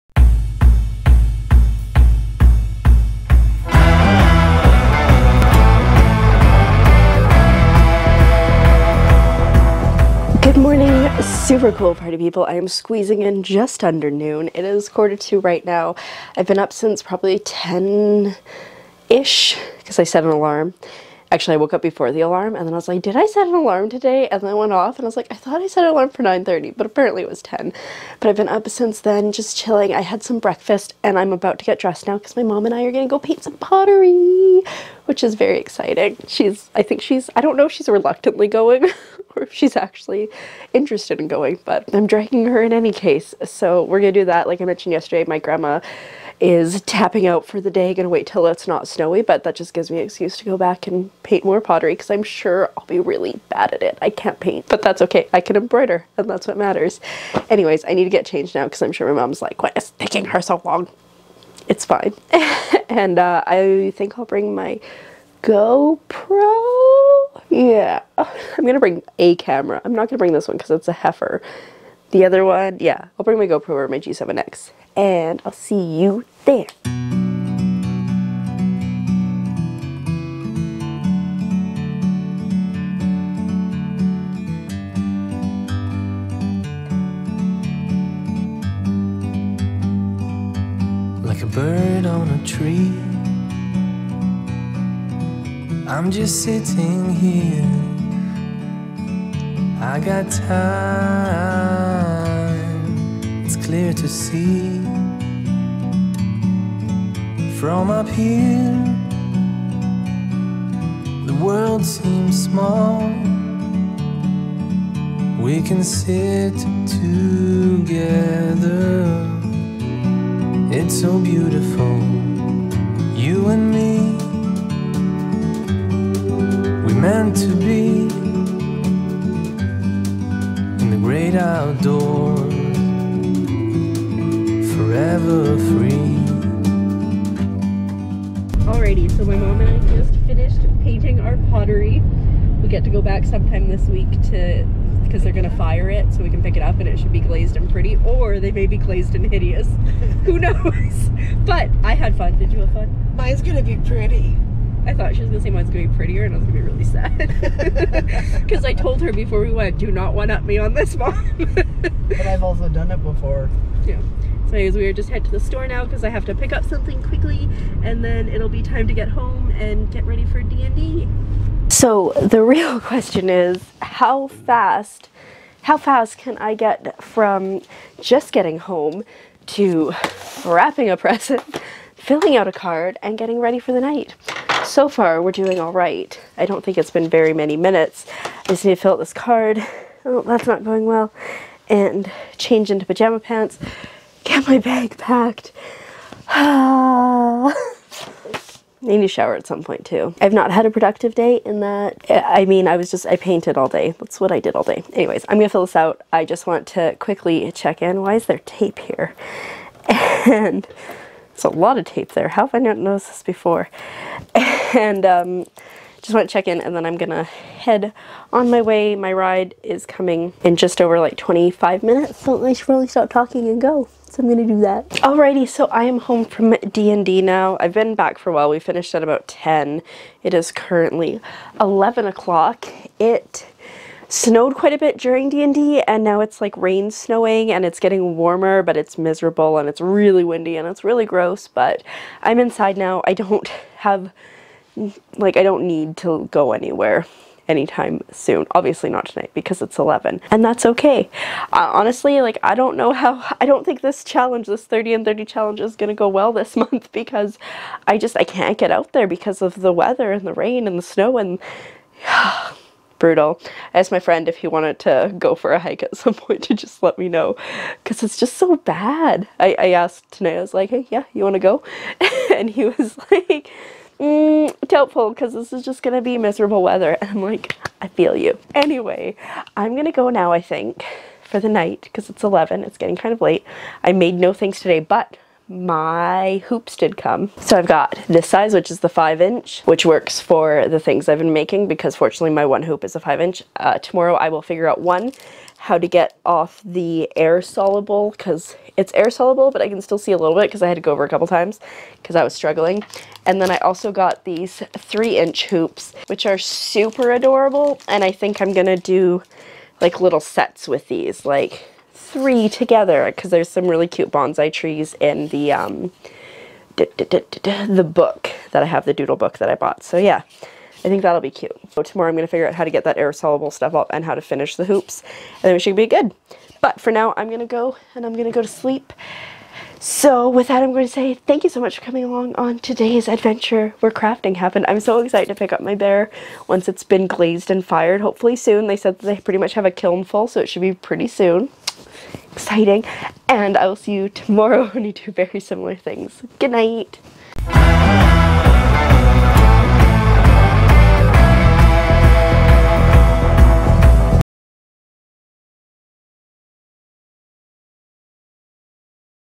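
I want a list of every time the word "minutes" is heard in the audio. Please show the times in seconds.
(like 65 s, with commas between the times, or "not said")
187 s, 221 s.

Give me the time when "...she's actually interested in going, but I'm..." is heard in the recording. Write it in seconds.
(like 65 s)
39 s.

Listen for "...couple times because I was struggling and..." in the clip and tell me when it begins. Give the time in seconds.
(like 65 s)
301 s.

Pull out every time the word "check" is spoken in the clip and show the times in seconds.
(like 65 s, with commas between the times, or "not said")
207 s, 216 s.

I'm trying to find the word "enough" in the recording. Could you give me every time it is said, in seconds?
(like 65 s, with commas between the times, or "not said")
not said.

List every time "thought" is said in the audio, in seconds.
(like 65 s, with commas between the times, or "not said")
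25 s, 154 s.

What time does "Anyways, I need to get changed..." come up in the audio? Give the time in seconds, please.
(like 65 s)
57 s.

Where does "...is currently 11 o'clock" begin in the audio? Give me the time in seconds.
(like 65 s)
230 s.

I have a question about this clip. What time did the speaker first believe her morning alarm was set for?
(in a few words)
9:30.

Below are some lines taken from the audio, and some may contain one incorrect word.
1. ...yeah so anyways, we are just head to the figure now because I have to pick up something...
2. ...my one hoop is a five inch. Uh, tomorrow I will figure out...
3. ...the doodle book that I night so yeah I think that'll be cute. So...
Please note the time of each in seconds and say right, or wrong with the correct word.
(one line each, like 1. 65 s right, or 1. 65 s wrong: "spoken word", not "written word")
1. 163 s wrong: "store", not "figure"
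2. 292 s right
3. 318 s wrong: "bought", not "night".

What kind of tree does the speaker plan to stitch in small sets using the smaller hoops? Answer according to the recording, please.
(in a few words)
Bonsai.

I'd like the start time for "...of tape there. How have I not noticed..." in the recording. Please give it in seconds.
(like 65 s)
211 s.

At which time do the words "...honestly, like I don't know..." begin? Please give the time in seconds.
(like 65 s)
251 s.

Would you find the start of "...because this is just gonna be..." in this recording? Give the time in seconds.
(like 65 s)
275 s.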